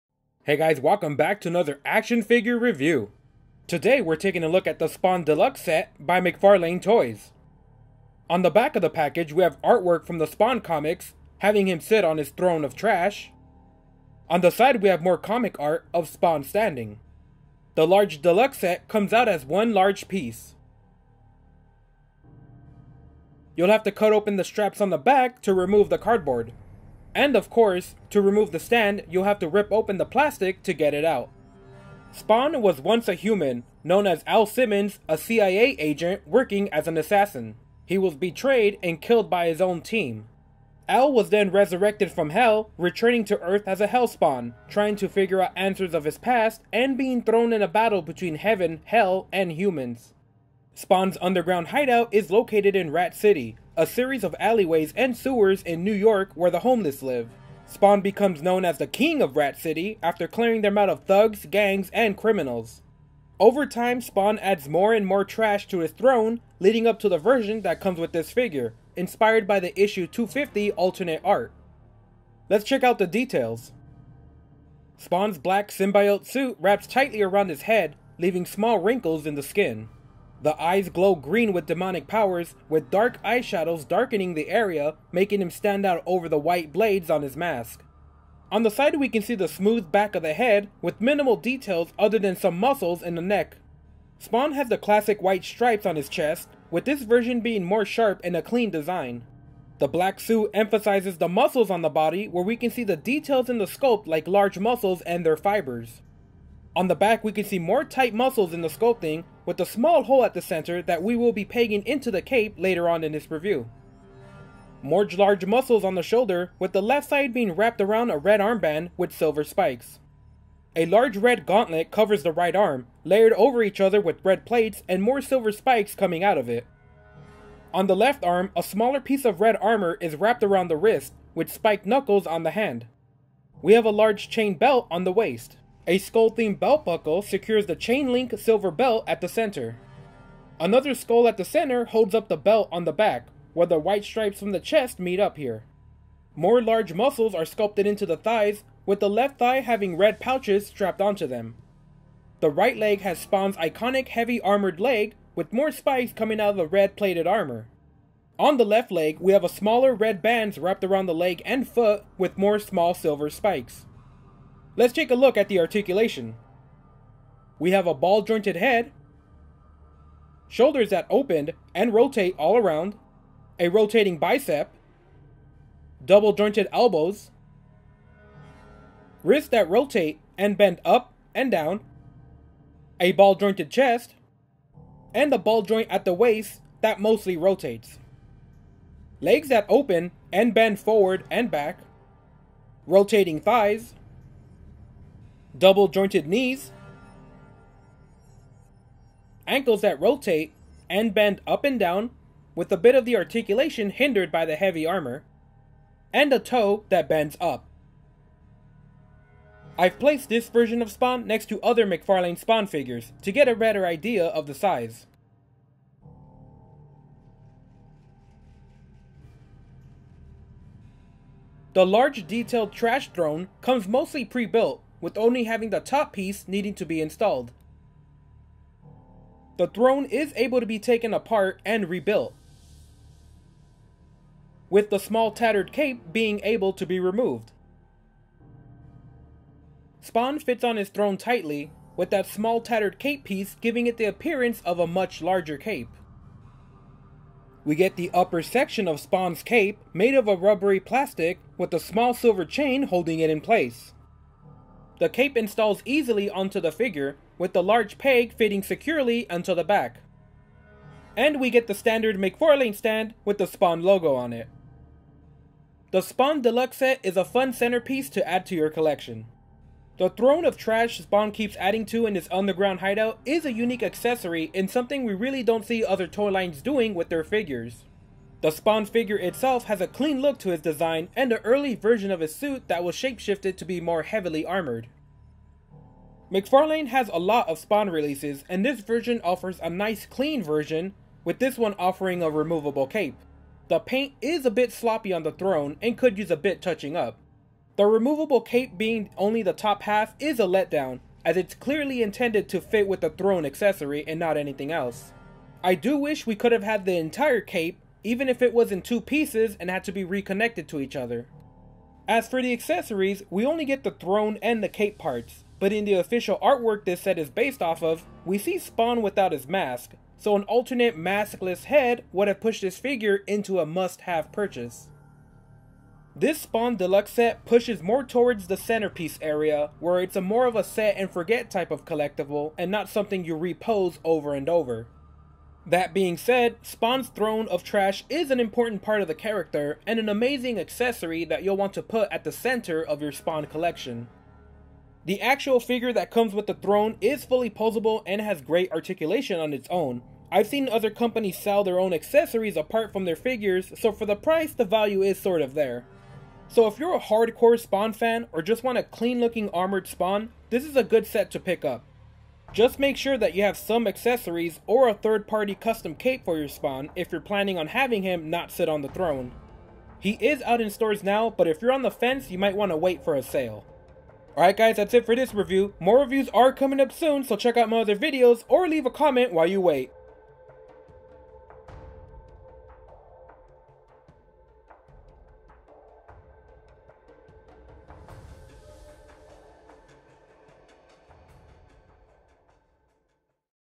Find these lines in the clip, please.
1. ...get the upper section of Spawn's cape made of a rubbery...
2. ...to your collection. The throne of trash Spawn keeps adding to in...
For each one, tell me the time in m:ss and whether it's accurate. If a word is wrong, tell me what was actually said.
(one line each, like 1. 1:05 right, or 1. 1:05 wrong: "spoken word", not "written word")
1. 4:07 right
2. 4:28 right.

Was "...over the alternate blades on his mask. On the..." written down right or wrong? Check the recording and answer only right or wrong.
wrong.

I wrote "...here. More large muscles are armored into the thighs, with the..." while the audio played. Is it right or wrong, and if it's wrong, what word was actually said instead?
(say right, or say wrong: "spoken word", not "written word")
wrong: "sculpted", not "armored".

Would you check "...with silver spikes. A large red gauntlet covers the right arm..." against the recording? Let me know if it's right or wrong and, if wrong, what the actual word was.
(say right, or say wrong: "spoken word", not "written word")
right.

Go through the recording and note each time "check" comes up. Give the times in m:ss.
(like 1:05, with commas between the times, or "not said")
1:12, 6:17.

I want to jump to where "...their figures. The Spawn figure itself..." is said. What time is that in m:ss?
4:37.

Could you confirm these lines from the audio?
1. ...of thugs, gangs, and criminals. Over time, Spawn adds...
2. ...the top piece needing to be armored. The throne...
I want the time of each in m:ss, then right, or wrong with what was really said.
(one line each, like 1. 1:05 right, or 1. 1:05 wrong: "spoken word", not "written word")
1. 1:00 right
2. 3:45 wrong: "installed", not "armored".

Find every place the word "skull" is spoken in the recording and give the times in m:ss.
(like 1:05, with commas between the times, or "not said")
2:15, 2:20.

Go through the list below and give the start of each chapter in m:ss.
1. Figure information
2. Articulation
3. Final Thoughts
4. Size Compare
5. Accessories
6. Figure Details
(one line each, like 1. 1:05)
1. 0:32
2. 2:47
3. 4:25
4. 3:29
5. 3:41
6. 1:14.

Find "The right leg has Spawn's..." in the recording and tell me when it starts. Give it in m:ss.
2:32.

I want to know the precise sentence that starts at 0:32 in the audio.
Spawn was once a human, known as Al Simmons, a CIA agent working as an assassin.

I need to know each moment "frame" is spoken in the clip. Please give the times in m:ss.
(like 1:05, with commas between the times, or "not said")
not said.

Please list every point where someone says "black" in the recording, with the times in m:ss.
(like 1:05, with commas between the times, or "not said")
1:15, 1:39.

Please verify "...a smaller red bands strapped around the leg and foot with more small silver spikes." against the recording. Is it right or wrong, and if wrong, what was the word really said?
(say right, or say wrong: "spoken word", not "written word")
wrong: "wrapped", not "strapped".